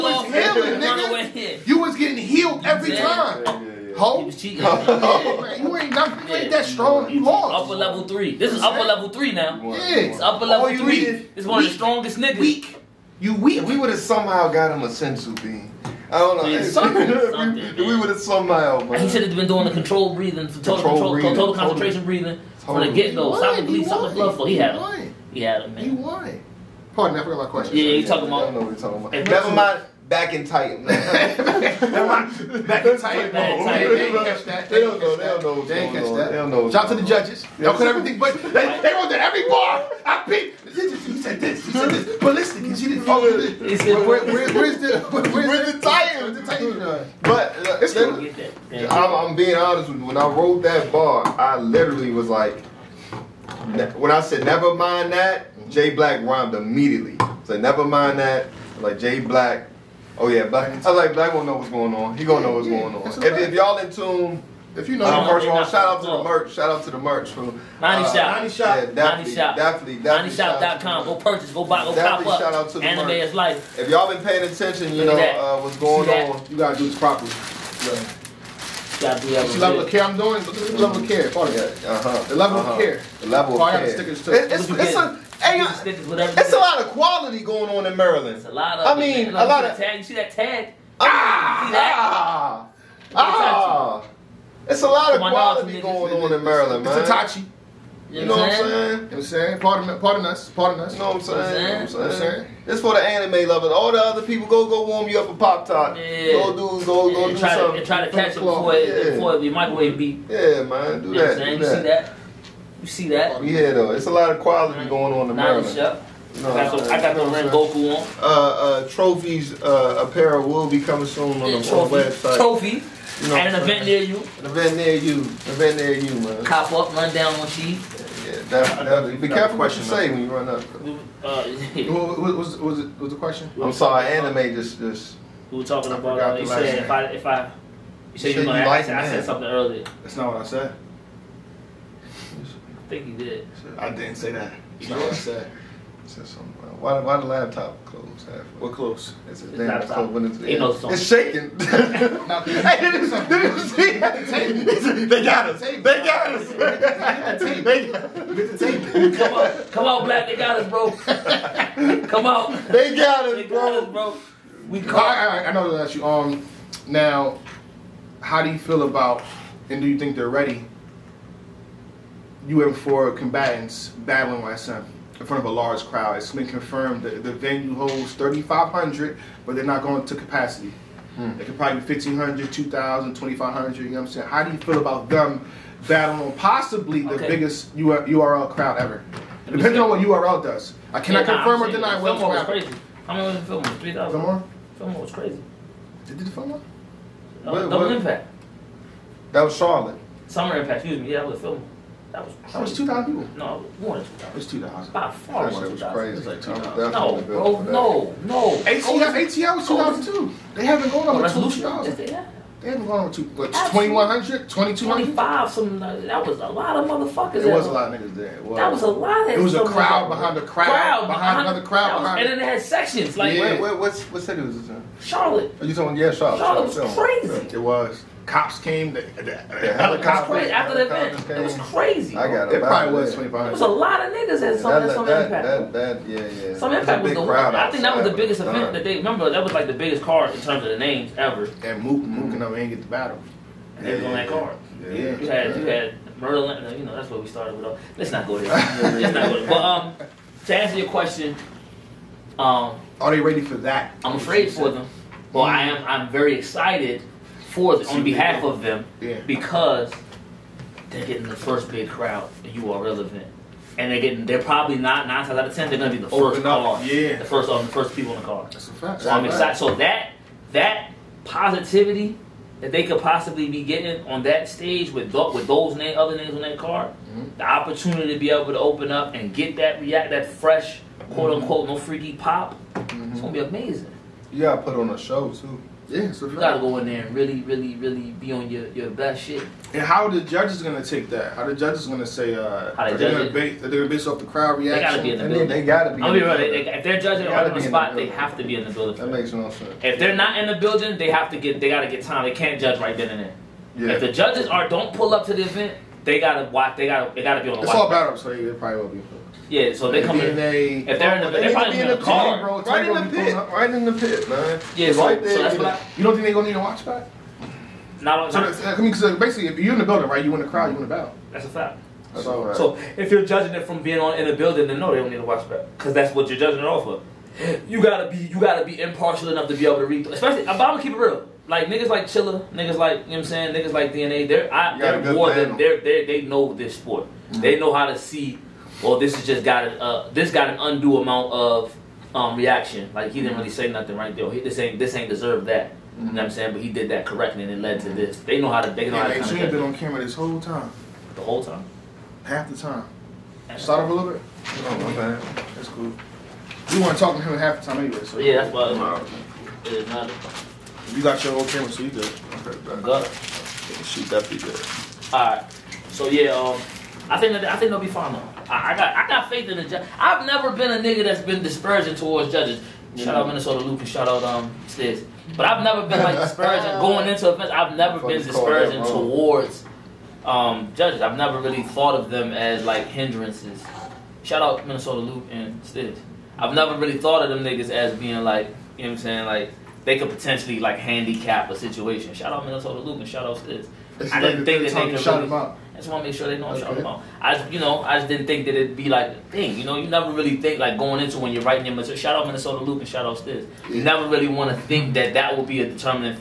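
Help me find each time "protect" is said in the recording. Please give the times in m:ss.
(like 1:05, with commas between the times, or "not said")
not said.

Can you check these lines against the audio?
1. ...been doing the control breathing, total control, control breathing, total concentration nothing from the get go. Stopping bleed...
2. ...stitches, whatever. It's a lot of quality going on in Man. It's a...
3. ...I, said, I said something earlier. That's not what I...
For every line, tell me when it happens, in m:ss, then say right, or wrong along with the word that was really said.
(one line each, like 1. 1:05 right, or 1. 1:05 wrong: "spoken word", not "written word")
1. 0:19 wrong: "breathing", not "nothing"
2. 1:25 wrong: "Maryland", not "Man"
3. 2:18 right.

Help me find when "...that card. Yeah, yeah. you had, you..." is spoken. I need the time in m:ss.
4:04.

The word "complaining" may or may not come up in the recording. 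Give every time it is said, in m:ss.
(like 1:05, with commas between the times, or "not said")
not said.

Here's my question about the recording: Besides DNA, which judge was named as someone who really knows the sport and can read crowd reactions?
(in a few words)
Chilla.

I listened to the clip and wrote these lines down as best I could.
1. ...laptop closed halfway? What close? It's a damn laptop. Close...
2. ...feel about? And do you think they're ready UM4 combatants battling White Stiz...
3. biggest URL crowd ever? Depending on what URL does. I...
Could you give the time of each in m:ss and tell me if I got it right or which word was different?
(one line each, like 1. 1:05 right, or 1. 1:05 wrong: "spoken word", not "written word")
1. 2:27 right
2. 2:48 wrong: "Sun", not "Stiz"
3. 3:07 right.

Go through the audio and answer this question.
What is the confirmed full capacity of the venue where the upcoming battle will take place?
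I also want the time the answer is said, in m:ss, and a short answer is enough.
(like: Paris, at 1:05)
3,500, at 2:58.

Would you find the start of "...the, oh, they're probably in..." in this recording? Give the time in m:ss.
5:11.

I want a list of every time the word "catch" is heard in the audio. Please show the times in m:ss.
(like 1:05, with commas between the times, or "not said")
0:35, 1:48.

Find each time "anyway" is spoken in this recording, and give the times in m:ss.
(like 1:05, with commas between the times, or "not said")
5:57.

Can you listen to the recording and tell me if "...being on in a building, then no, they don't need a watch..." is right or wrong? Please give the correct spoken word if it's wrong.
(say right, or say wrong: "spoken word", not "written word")
right.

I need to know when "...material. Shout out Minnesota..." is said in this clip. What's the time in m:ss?
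6:41.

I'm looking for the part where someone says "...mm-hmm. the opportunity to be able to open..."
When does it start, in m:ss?
4:36.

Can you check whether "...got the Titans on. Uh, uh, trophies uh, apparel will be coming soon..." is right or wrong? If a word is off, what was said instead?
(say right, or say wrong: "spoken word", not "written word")
wrong: "Rengoku", not "Titans".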